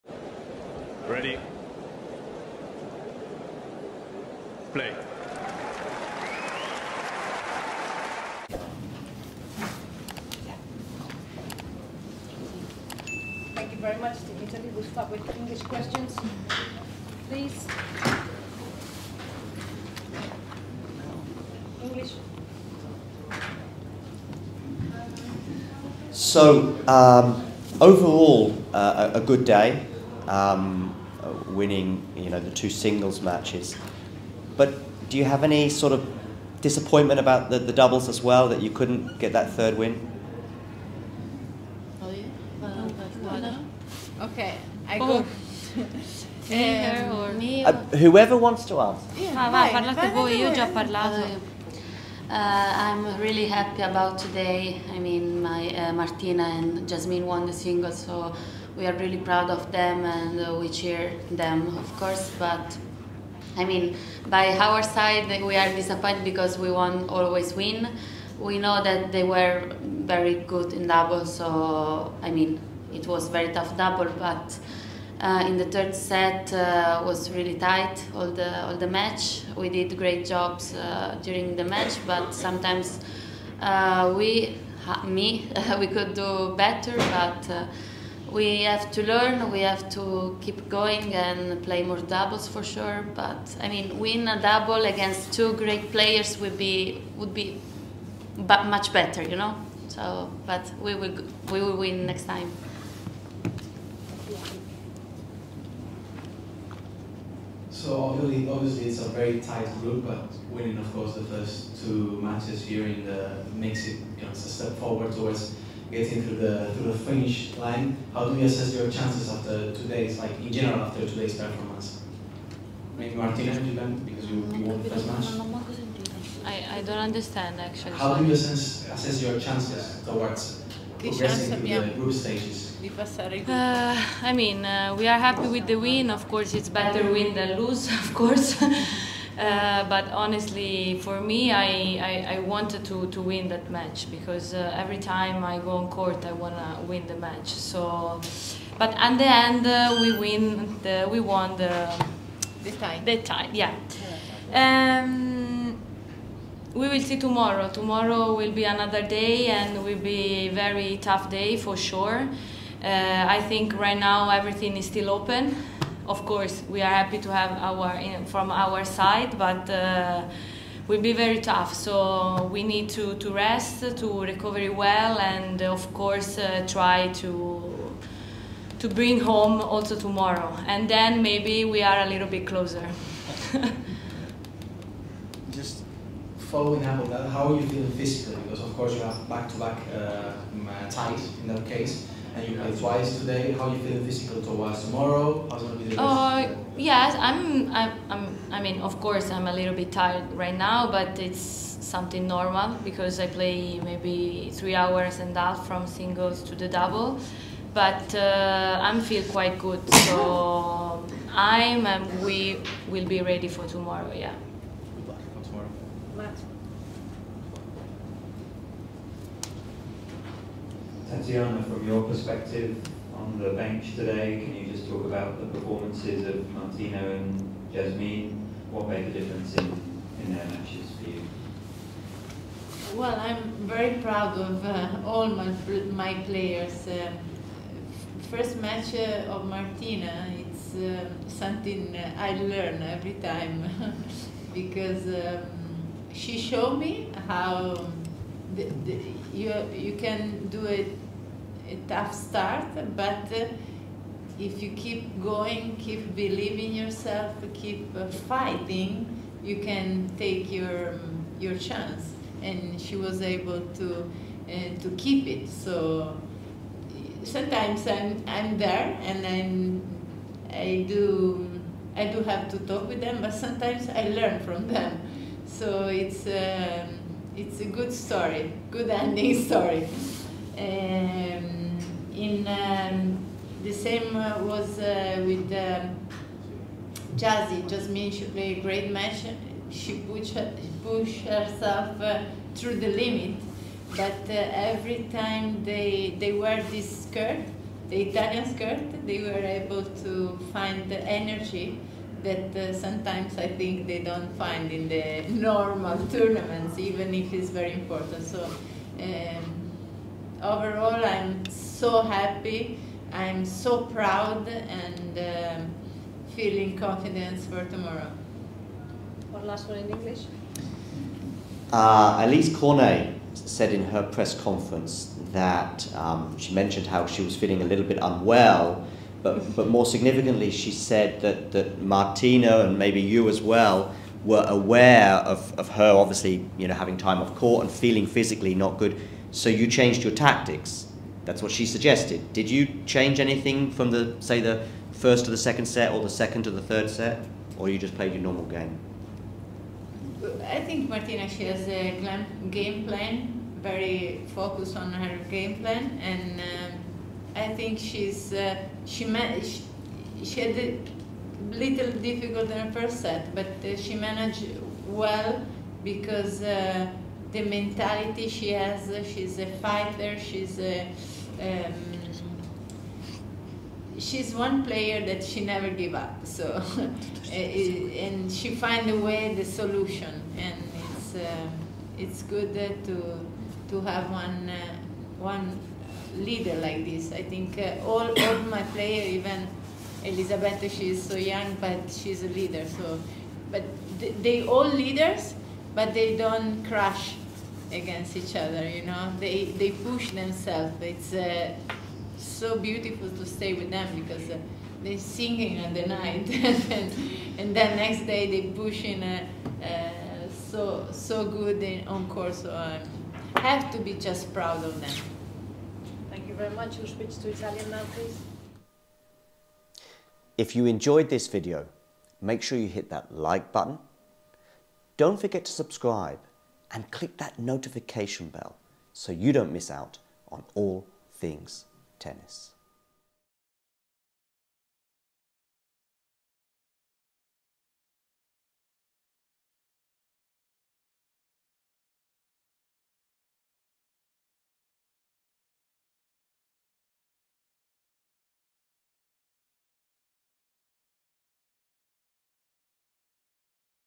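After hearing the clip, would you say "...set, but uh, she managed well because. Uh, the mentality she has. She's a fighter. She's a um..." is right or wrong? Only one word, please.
right.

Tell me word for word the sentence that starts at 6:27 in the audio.
I think uh, all all my player, even Elisabetta, she is so young, but she's a leader.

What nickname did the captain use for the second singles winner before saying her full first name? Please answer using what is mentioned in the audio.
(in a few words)
Jazzy.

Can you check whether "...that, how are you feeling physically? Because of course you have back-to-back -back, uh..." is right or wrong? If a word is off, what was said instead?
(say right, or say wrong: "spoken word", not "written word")
right.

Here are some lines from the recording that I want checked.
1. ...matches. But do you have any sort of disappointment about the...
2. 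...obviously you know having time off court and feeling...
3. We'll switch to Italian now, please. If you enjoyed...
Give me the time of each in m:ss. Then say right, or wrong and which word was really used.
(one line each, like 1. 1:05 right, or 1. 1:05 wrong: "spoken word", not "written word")
1. 0:33 right
2. 5:35 right
3. 6:56 right.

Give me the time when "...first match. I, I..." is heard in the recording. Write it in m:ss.
2:04.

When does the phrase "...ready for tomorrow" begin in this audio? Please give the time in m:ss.
3:33.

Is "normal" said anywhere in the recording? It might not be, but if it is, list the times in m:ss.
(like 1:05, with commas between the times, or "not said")
3:22, 5:05, 5:48.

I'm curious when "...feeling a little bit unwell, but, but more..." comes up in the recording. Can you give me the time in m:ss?
5:27.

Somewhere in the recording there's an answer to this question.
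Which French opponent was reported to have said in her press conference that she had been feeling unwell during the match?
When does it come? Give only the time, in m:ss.
5:22.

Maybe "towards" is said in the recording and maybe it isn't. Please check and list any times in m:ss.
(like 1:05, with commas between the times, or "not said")
1:55, 2:10, 3:14.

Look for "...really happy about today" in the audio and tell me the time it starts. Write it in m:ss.
0:53.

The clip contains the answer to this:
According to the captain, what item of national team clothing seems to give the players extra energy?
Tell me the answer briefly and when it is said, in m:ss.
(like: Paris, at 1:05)
the Italian skirt, at 4:57.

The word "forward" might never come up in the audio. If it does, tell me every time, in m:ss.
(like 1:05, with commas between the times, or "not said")
1:54.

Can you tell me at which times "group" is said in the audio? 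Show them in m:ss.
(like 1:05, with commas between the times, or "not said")
1:49, 2:11.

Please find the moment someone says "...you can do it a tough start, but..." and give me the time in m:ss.
4:09.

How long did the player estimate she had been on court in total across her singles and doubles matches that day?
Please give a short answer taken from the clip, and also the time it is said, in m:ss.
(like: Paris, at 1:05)
3.5 hours, at 3:24.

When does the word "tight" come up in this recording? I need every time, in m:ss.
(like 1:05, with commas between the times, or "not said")
1:17, 1:49.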